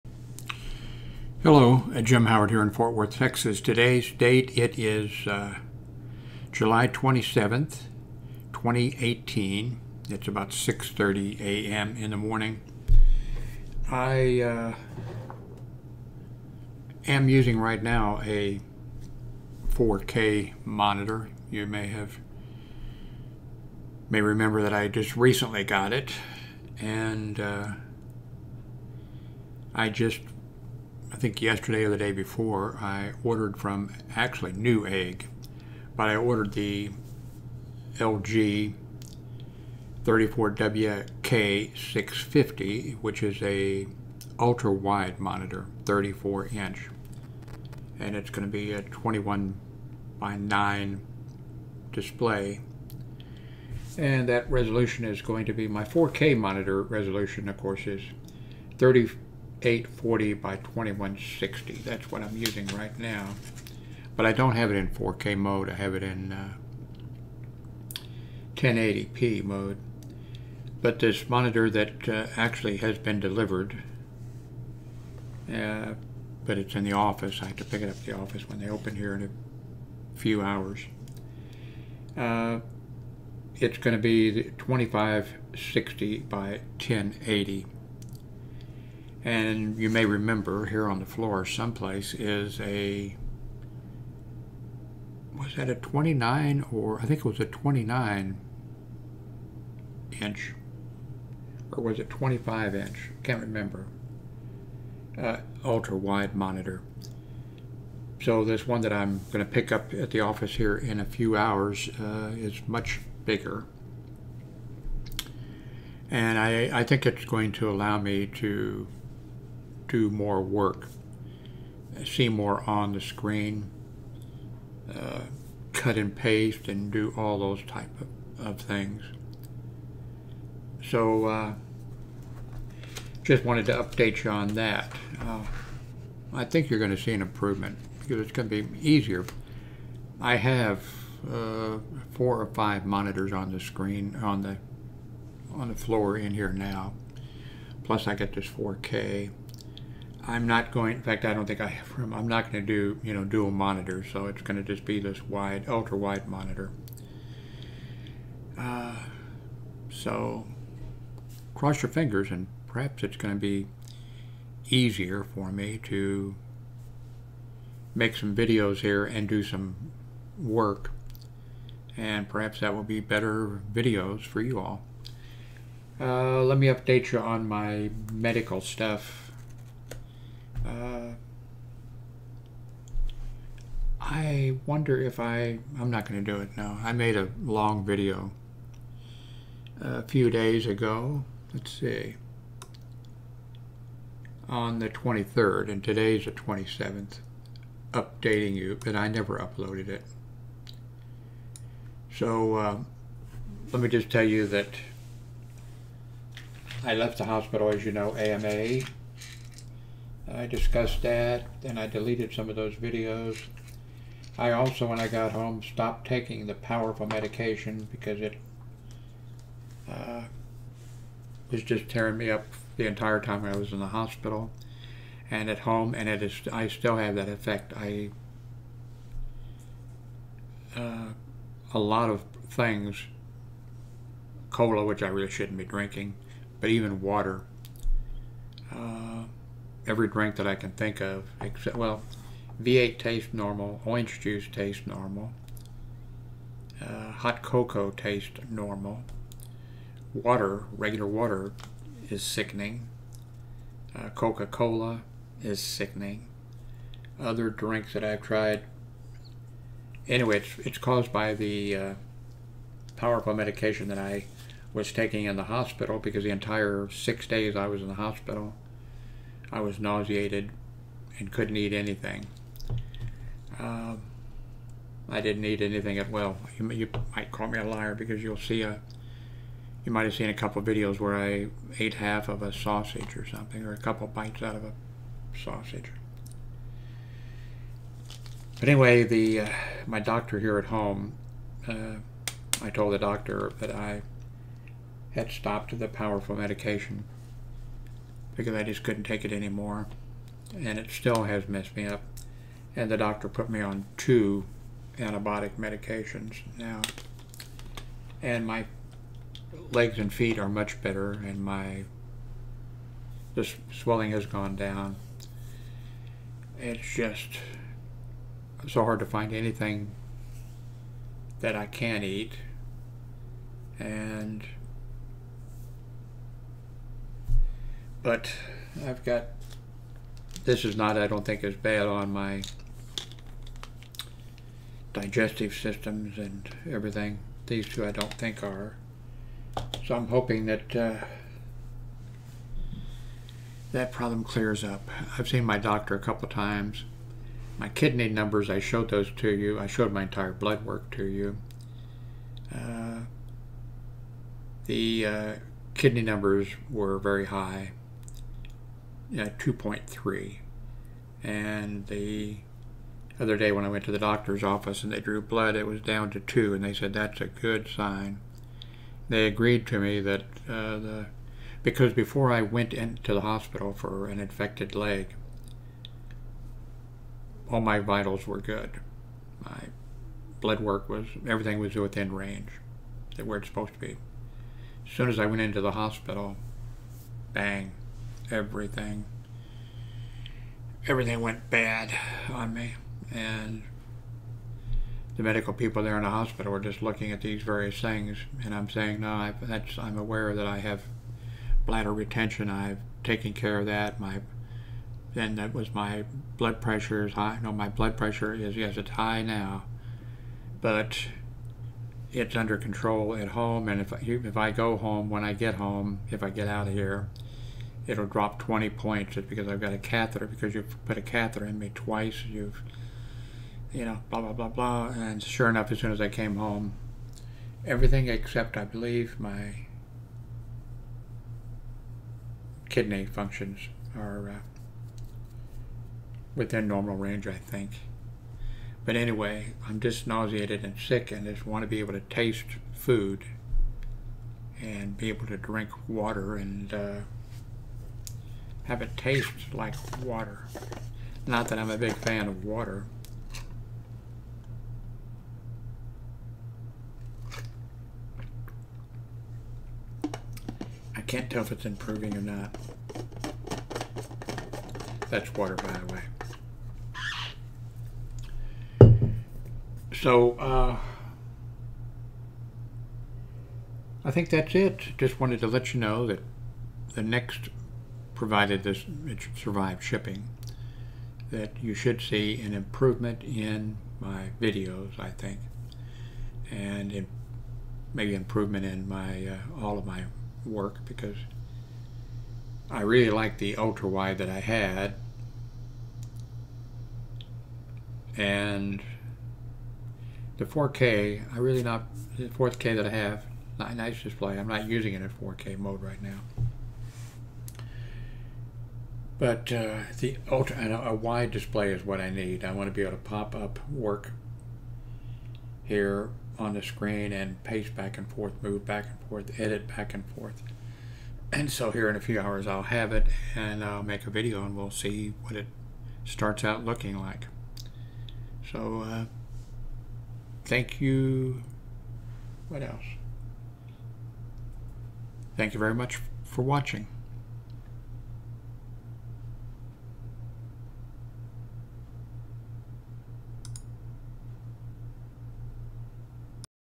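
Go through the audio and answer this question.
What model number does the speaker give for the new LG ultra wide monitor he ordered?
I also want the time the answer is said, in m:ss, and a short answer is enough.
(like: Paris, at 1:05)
34WK650, at 0:40.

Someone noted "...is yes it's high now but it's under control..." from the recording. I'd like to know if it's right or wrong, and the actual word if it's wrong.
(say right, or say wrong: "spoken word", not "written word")
right.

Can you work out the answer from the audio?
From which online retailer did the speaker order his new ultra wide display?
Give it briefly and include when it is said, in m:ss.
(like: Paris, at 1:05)
Newegg, at 0:34.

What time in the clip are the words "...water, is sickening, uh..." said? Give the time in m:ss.
4:11.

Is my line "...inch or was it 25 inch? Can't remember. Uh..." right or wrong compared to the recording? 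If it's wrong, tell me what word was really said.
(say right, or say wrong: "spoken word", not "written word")
right.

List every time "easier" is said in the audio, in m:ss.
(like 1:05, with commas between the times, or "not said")
2:18, 2:44.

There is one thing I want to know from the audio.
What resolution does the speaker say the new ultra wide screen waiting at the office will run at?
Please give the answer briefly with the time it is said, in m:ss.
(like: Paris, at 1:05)
2560 by 1080, at 1:24.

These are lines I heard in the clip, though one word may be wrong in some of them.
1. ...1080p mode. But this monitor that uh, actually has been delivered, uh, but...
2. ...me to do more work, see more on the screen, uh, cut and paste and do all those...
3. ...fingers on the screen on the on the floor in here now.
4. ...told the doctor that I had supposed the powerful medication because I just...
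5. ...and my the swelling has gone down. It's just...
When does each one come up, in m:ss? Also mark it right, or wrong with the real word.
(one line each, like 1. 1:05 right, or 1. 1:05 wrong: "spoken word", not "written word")
1. 1:08 right
2. 1:57 right
3. 2:22 wrong: "monitors", not "fingers"
4. 4:52 wrong: "stopped", not "supposed"
5. 5:11 right.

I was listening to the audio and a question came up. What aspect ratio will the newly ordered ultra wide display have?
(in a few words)
21 by 9.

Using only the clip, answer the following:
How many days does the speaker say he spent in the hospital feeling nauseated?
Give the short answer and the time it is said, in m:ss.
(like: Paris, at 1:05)
6, at 4:26.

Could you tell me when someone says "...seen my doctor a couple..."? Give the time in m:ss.
5:45.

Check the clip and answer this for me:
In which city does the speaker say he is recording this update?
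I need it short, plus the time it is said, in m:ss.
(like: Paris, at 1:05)
Fort Worth, at 0:02.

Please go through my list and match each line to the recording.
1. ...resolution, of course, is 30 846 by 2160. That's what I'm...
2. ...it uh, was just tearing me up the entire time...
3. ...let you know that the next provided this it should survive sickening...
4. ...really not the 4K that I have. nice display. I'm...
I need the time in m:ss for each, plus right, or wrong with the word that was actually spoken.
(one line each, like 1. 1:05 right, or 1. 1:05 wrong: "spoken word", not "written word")
1. 0:56 wrong: "840", not "846"
2. 3:38 right
3. 7:55 wrong: "shipping", not "sickening"
4. 8:21 right.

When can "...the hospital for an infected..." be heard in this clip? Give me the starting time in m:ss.
6:13.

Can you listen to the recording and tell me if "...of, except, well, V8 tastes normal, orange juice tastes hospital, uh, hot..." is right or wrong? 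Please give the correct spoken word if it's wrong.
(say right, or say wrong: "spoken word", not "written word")
wrong: "normal", not "hospital".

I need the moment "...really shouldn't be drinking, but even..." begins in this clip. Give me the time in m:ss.
3:55.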